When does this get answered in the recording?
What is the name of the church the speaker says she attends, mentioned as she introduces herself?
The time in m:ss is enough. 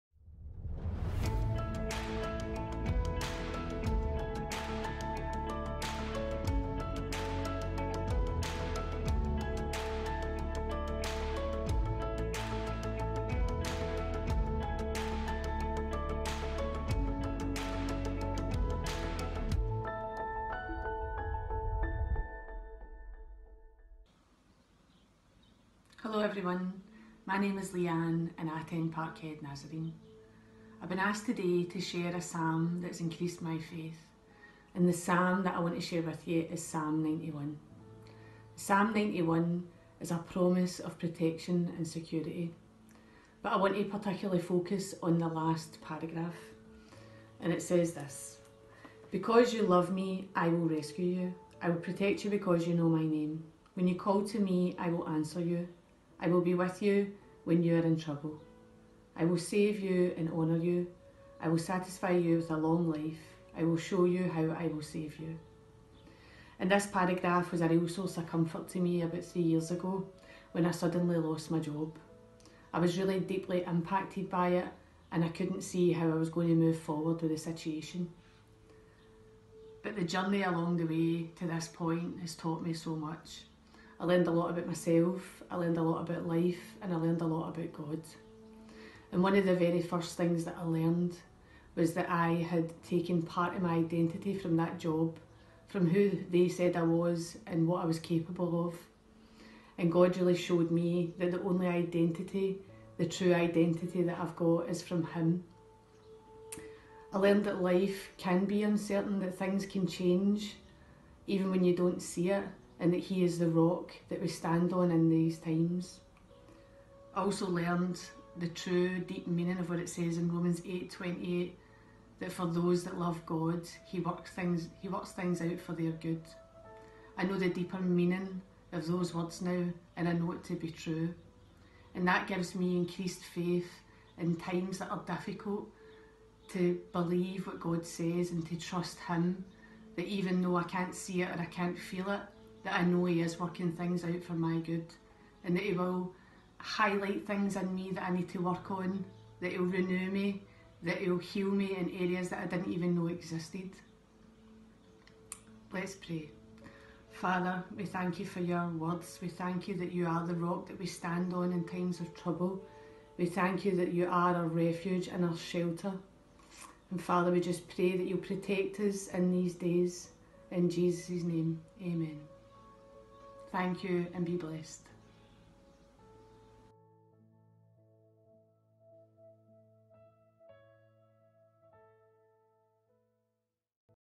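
0:28.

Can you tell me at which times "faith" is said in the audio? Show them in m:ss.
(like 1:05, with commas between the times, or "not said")
0:33, 2:13.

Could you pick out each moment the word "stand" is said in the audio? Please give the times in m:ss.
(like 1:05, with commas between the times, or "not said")
1:54, 2:40.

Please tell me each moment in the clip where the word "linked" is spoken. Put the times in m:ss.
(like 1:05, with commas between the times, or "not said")
not said.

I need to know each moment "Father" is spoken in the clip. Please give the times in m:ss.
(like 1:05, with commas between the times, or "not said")
2:37, 2:47.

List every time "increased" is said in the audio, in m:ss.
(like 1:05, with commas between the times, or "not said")
0:33, 2:12.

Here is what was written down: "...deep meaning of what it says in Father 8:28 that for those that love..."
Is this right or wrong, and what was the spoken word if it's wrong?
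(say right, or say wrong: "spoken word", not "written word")
wrong: "Romans", not "Father".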